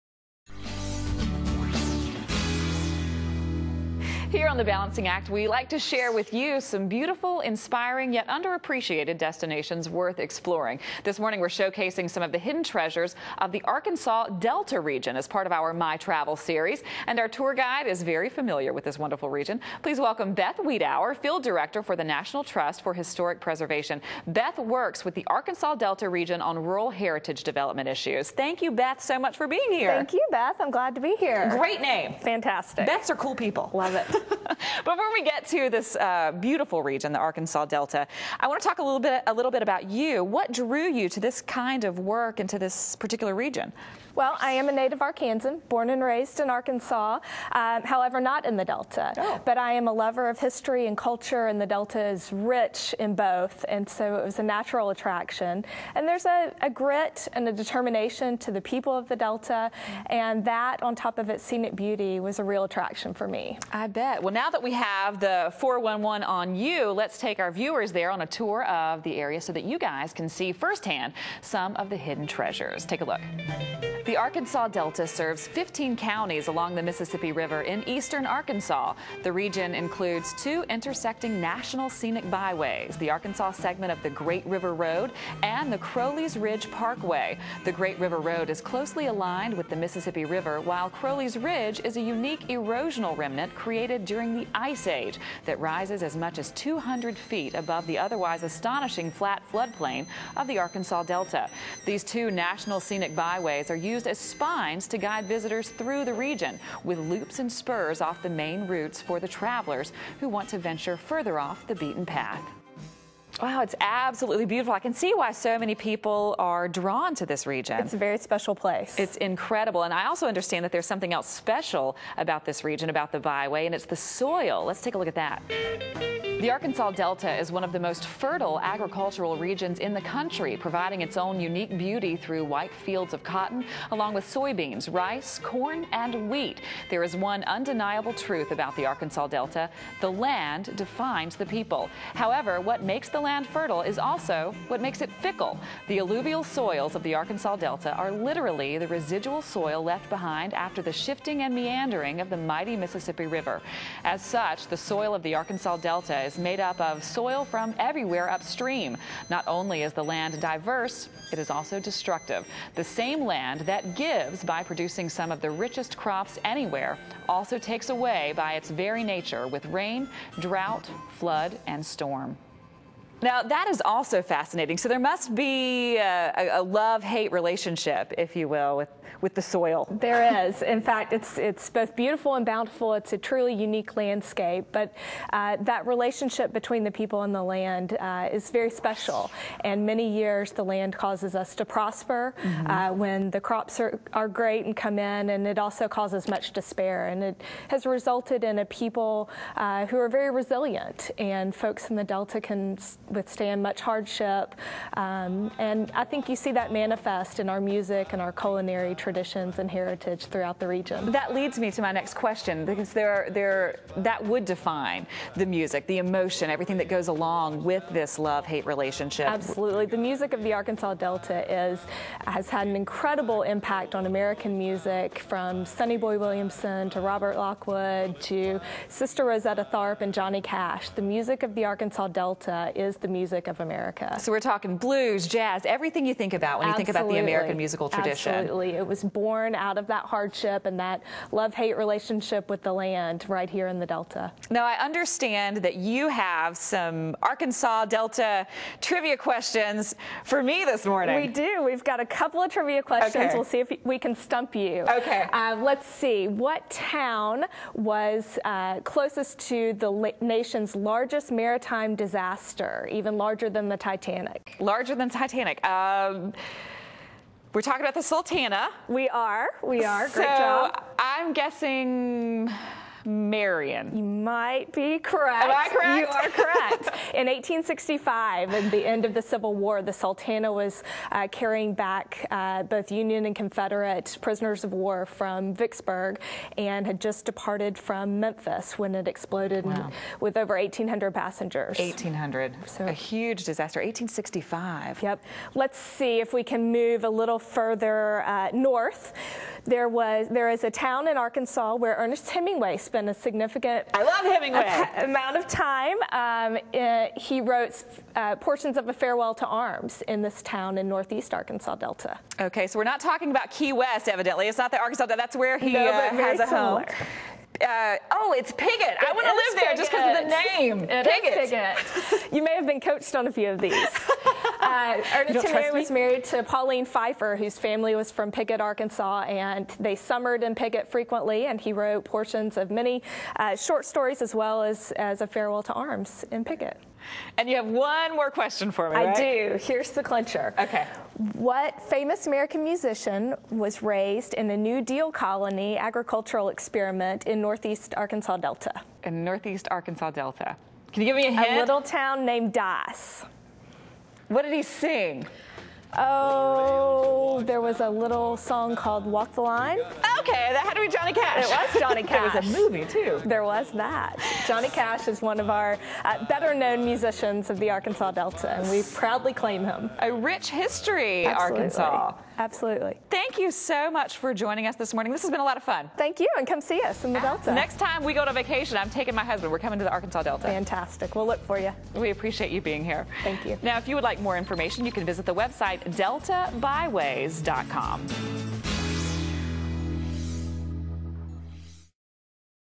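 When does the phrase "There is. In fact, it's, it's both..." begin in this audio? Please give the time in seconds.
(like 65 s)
180 s.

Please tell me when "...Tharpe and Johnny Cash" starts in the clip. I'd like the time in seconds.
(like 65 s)
229 s.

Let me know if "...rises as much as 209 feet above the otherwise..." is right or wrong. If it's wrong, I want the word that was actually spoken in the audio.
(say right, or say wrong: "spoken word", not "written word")
wrong: "200", not "209".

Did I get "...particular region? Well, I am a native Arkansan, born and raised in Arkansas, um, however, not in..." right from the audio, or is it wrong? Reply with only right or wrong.
right.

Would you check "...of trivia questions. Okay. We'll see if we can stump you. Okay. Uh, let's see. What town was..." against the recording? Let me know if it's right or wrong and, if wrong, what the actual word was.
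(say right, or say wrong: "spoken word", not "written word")
right.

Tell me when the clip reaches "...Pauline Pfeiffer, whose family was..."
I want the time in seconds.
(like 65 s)
326 s.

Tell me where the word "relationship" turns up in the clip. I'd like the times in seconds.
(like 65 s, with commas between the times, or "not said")
177 s, 185 s, 218 s, 241 s.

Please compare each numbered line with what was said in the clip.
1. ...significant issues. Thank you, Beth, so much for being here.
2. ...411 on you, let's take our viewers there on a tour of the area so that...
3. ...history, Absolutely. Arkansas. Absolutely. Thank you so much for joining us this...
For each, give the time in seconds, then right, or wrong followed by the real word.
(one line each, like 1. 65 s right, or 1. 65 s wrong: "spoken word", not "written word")
1. 27 s wrong: "development", not "significant"
2. 65 s right
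3. 370 s right.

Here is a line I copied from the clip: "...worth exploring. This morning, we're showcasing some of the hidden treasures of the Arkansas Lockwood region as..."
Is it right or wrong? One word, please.
wrong.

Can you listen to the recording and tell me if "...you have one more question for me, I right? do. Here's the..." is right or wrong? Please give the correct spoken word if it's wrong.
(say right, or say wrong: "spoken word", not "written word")
right.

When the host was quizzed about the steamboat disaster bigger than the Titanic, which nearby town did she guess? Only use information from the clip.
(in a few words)
Marion.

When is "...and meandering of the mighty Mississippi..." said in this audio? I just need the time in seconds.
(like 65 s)
151 s.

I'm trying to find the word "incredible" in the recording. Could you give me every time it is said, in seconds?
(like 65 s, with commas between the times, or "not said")
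119 s, 222 s.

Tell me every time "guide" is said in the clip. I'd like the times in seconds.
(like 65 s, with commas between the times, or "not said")
17 s, 104 s.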